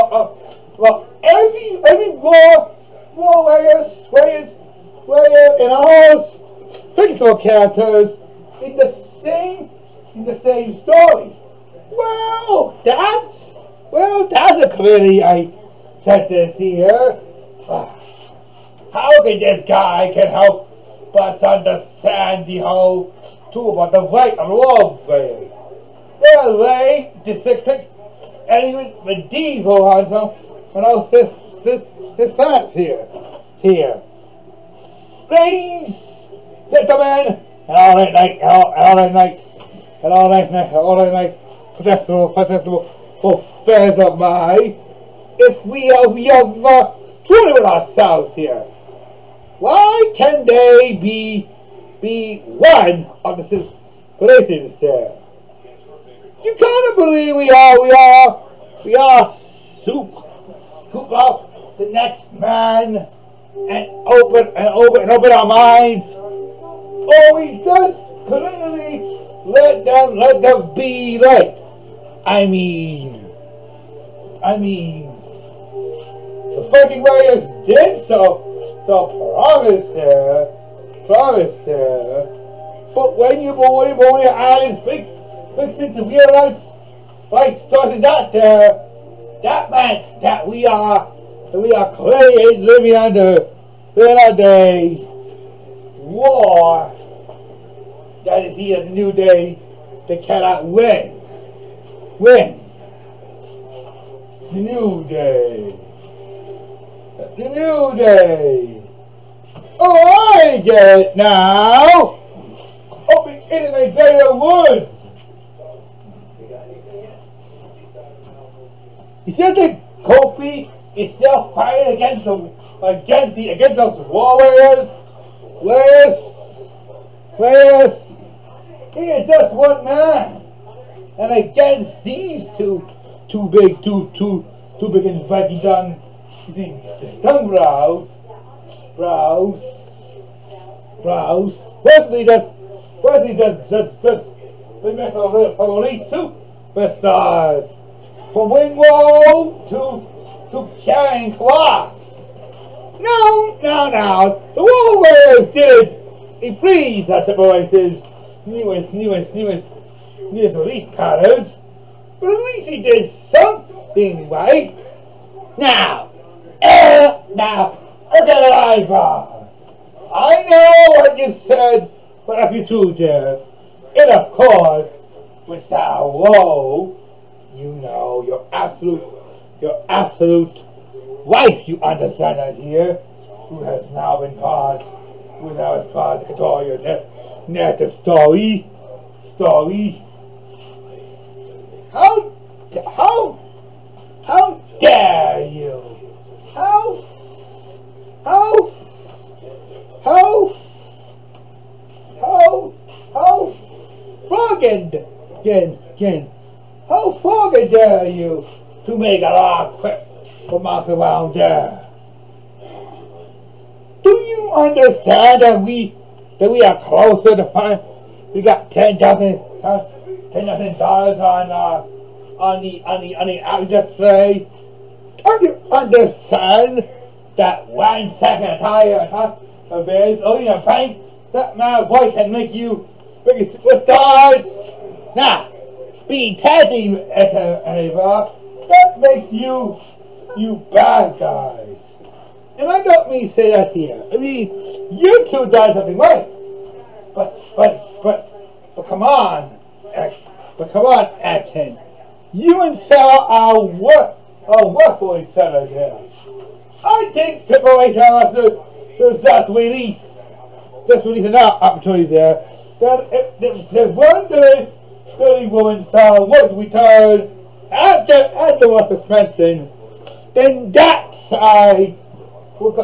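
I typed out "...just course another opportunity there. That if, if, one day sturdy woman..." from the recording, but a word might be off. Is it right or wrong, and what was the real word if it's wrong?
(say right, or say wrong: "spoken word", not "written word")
wrong: "release", not "course".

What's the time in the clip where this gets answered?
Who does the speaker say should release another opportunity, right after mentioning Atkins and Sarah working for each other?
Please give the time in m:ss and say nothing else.
4:17.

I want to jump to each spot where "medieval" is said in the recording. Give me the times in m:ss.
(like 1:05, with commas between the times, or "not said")
0:29.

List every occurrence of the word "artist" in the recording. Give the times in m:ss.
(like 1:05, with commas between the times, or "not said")
not said.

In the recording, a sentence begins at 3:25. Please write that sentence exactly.
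Jin, Jin, how far dare you to make a lot trip for us around there?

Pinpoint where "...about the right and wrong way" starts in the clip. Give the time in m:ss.
0:23.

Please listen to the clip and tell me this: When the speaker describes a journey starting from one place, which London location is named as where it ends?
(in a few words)
Charing Cross.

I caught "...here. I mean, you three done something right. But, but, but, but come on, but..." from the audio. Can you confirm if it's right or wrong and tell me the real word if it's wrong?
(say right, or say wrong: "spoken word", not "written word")
wrong: "two", not "three".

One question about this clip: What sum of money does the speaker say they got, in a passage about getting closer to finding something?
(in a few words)
$10,000.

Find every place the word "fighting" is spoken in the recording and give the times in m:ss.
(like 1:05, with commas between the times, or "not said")
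2:01, 2:15.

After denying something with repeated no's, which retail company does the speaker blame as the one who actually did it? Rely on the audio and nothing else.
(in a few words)
Woolworths.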